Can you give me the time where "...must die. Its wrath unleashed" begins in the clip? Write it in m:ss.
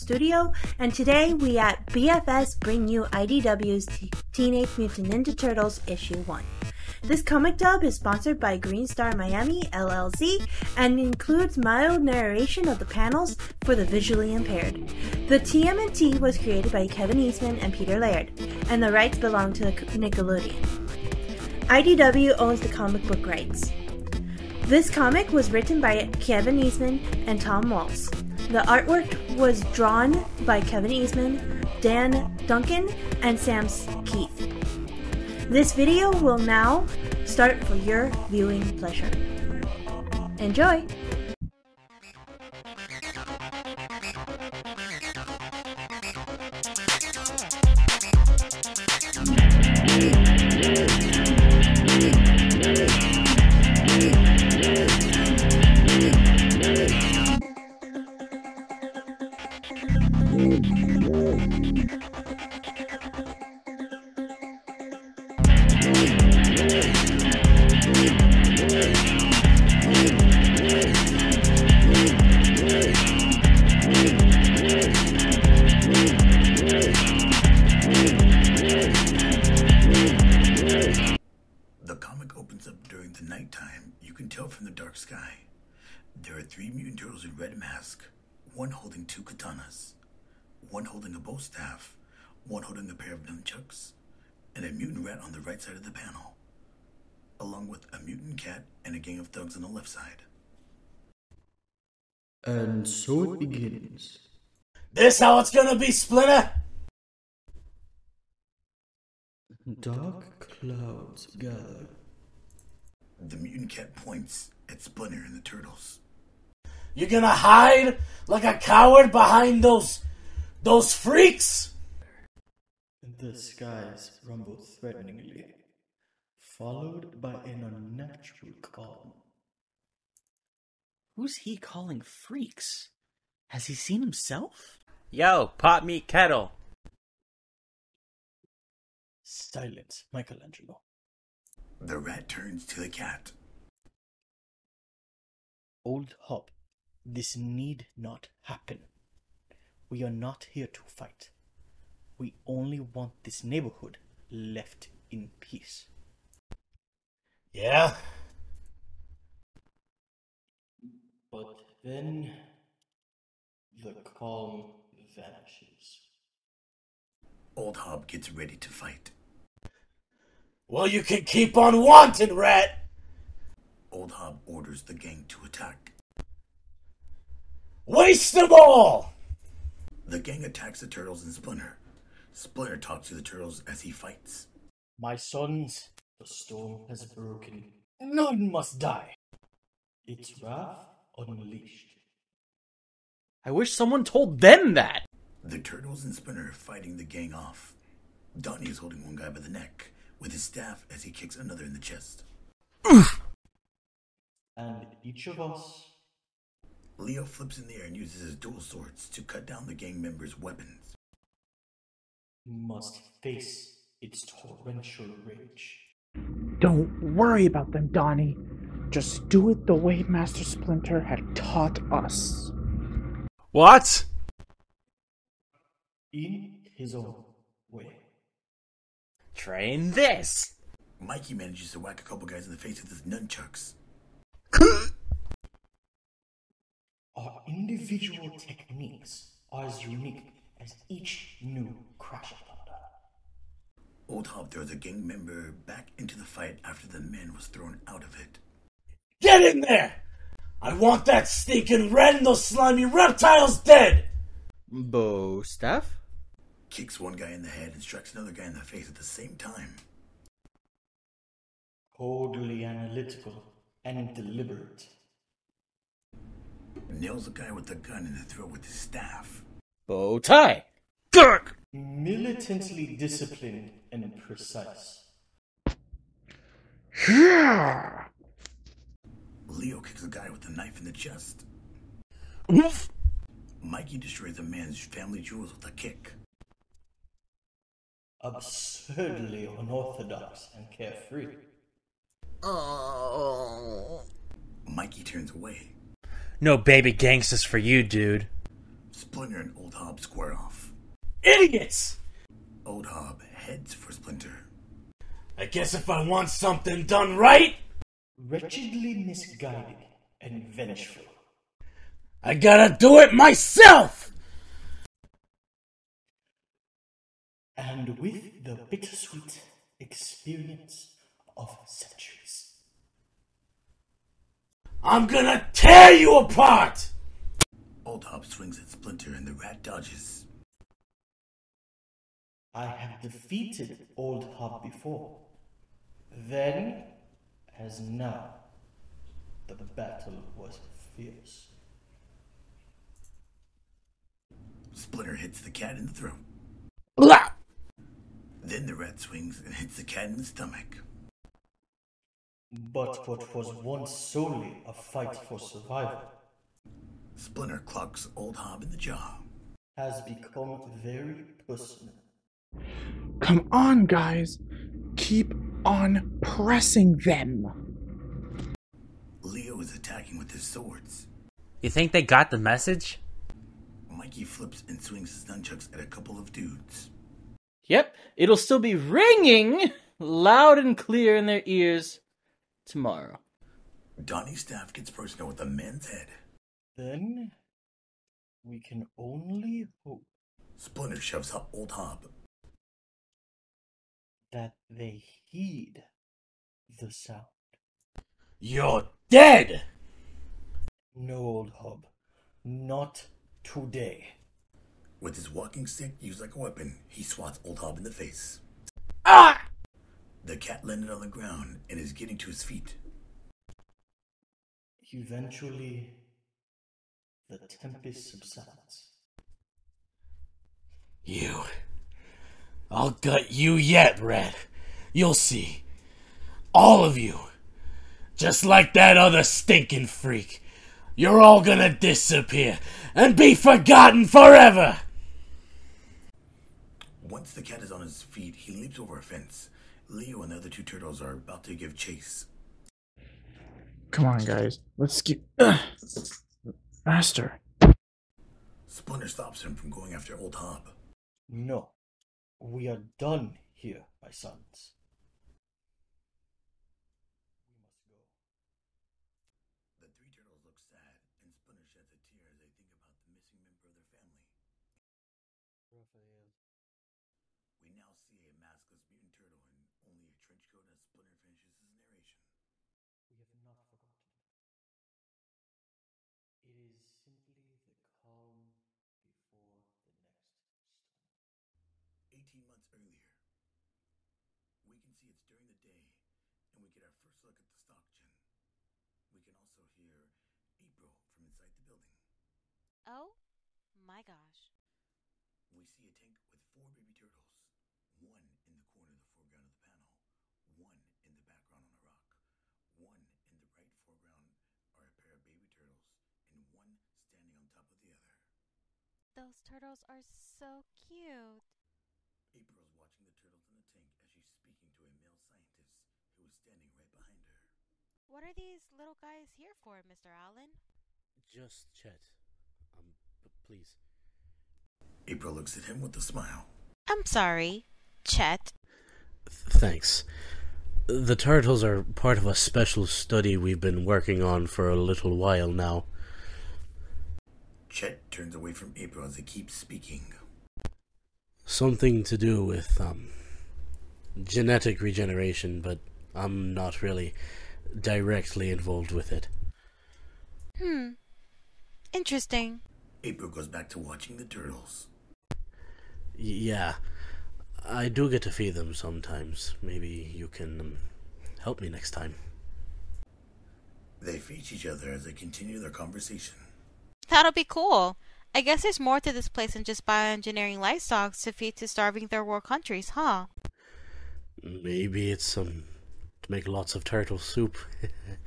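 3:08.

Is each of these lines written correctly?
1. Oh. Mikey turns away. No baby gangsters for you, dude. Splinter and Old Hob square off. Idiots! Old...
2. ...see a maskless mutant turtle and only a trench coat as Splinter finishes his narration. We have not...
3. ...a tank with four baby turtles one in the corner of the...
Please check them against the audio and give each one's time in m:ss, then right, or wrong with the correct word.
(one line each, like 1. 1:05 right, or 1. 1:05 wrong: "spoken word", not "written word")
1. 4:52 right
2. 7:47 right
3. 8:15 right.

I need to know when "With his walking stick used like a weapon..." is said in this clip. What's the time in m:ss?
6:44.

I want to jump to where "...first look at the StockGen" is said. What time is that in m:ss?
8:06.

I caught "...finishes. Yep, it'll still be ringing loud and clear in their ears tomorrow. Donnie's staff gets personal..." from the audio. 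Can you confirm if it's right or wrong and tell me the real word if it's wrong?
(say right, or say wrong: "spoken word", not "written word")
wrong: "dudes", not "finishes".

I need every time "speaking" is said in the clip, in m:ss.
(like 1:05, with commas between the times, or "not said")
8:34, 8:59.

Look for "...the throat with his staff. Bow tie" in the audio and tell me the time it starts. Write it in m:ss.
4:28.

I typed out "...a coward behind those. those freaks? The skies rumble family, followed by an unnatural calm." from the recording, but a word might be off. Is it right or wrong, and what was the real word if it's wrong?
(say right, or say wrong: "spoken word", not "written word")
wrong: "threateningly", not "family".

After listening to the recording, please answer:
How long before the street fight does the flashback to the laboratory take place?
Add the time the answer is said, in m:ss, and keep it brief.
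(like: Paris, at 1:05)
18 months, at 8:02.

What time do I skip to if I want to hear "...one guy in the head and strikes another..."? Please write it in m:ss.
4:16.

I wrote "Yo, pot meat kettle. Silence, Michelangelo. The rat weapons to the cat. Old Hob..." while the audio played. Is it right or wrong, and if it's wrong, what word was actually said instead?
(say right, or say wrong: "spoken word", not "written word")
wrong: "turns", not "weapons".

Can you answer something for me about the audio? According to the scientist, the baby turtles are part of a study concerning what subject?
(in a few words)
genetic regeneration.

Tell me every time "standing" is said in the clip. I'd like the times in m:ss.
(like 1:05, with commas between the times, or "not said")
8:26, 8:36.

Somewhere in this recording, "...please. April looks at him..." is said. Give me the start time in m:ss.
8:43.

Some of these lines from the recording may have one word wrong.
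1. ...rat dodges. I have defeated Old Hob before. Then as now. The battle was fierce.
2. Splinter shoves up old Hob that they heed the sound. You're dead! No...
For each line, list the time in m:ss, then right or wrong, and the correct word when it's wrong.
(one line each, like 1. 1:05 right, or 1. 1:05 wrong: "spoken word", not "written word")
1. 5:29 right
2. 6:30 right.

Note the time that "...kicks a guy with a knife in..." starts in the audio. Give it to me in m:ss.
4:39.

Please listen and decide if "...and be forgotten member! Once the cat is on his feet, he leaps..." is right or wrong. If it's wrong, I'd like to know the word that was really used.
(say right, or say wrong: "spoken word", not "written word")
wrong: "forever", not "member".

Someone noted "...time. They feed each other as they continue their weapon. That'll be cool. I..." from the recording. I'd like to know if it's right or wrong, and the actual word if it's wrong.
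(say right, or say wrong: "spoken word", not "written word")
wrong: "conversation", not "weapon".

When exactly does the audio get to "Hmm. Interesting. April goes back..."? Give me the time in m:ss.
9:10.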